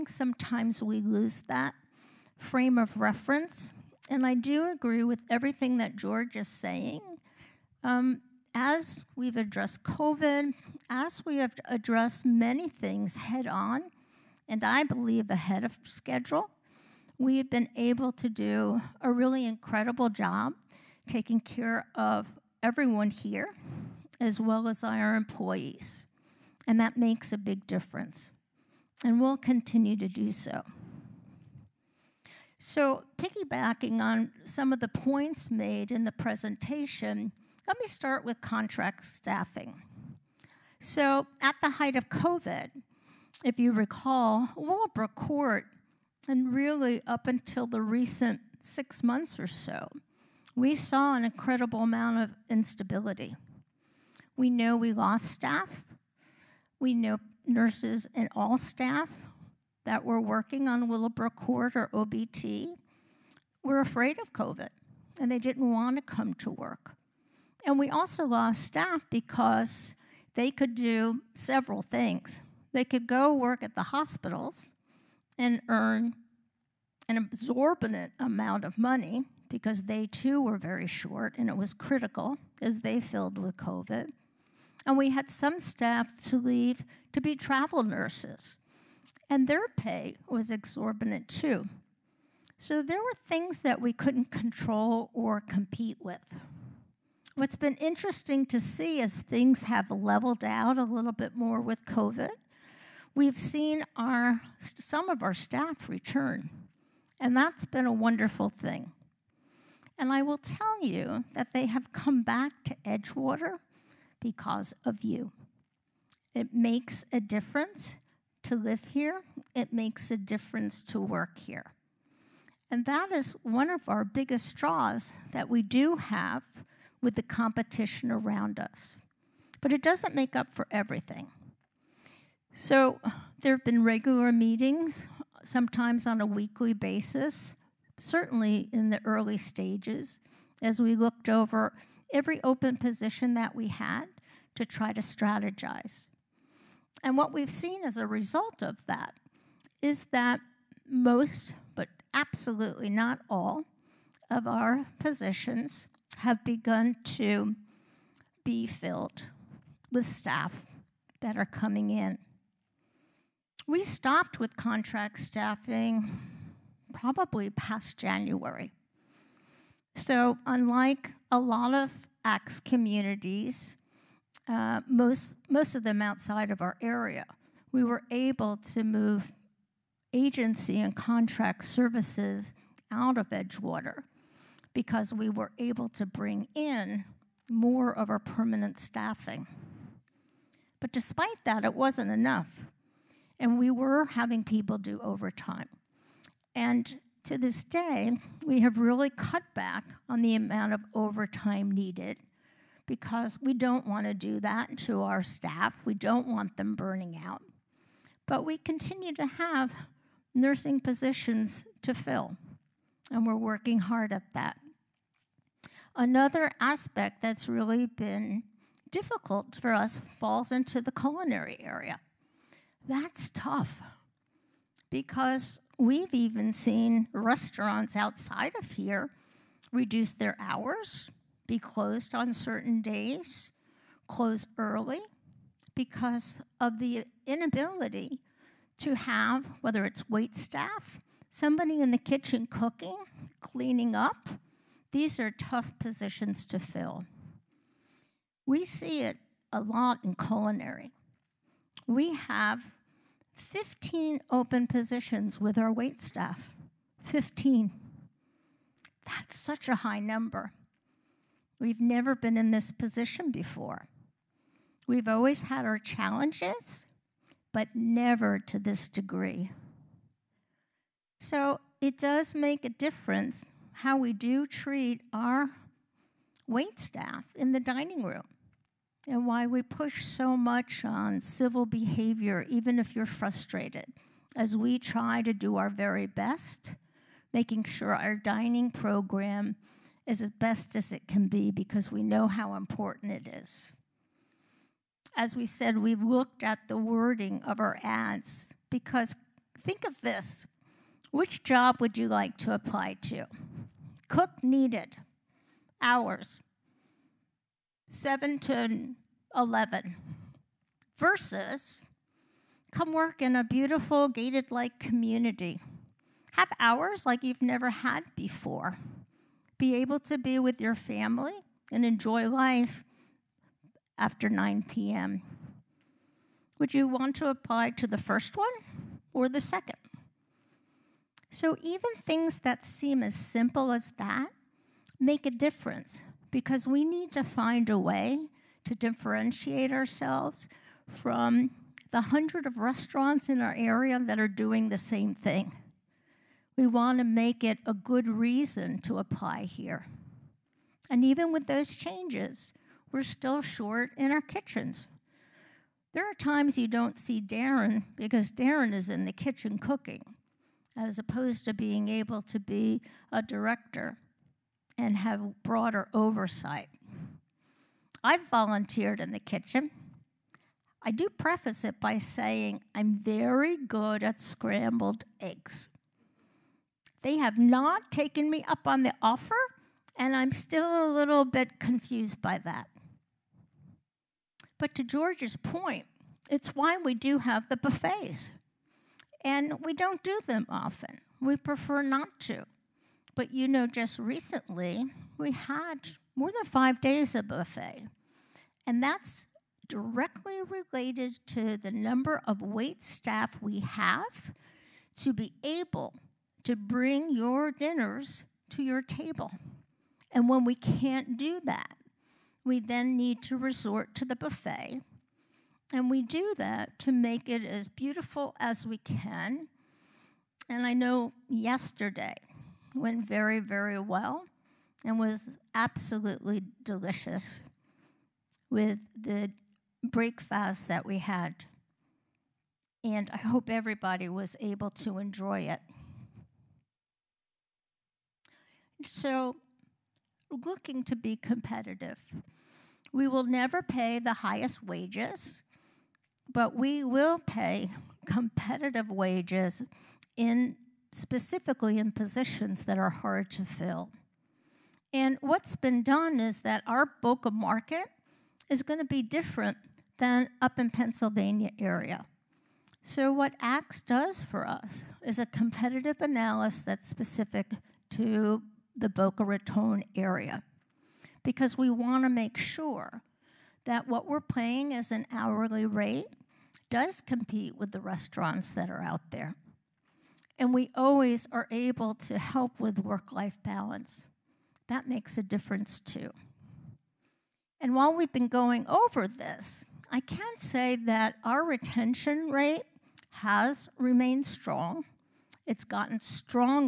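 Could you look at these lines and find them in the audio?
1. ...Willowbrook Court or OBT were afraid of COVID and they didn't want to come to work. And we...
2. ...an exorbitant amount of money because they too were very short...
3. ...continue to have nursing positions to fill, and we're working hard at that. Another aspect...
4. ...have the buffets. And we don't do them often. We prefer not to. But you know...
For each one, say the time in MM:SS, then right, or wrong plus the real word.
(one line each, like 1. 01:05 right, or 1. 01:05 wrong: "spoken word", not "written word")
1. 01:00 right
2. 01:17 right
3. 03:28 right
4. 06:27 right.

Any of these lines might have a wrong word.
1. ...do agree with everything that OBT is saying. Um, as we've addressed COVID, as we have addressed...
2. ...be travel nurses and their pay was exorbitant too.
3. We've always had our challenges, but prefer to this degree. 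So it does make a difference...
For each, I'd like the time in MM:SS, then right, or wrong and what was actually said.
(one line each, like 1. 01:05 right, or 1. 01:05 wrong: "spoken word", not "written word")
1. 00:04 wrong: "George", not "OBT"
2. 01:27 right
3. 04:24 wrong: "never", not "prefer".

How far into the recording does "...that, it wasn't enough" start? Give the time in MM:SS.
03:11.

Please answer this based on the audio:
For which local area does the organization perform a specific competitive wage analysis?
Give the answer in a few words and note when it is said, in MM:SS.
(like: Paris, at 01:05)
Boca Raton, at 07:48.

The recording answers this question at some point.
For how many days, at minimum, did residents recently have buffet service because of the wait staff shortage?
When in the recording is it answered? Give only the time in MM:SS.
06:36.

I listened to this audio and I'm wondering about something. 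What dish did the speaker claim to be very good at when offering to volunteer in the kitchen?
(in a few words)
Scrambled eggs.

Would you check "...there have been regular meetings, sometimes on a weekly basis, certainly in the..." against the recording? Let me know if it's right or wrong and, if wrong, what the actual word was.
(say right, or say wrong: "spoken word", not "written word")
right.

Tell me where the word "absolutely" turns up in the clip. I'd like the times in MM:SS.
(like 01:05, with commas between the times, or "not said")
02:32, 07:05.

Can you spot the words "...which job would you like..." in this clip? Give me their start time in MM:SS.
05:01.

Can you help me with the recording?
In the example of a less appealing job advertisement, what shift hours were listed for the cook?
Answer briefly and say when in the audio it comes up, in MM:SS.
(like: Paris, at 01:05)
7 to 11, at 05:07.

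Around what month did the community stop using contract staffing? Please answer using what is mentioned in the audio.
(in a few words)
January.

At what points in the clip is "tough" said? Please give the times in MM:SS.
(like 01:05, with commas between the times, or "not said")
03:43, 04:05.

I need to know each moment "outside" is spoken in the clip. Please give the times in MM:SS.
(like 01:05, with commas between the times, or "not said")
02:55, 03:47.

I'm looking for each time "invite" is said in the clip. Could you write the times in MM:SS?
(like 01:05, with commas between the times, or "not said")
not said.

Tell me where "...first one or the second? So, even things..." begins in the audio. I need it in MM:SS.
05:27.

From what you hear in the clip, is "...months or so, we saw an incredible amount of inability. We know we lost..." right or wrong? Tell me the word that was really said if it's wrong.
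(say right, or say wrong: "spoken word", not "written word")
wrong: "instability", not "inability".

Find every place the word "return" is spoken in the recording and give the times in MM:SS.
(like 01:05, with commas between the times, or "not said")
01:45.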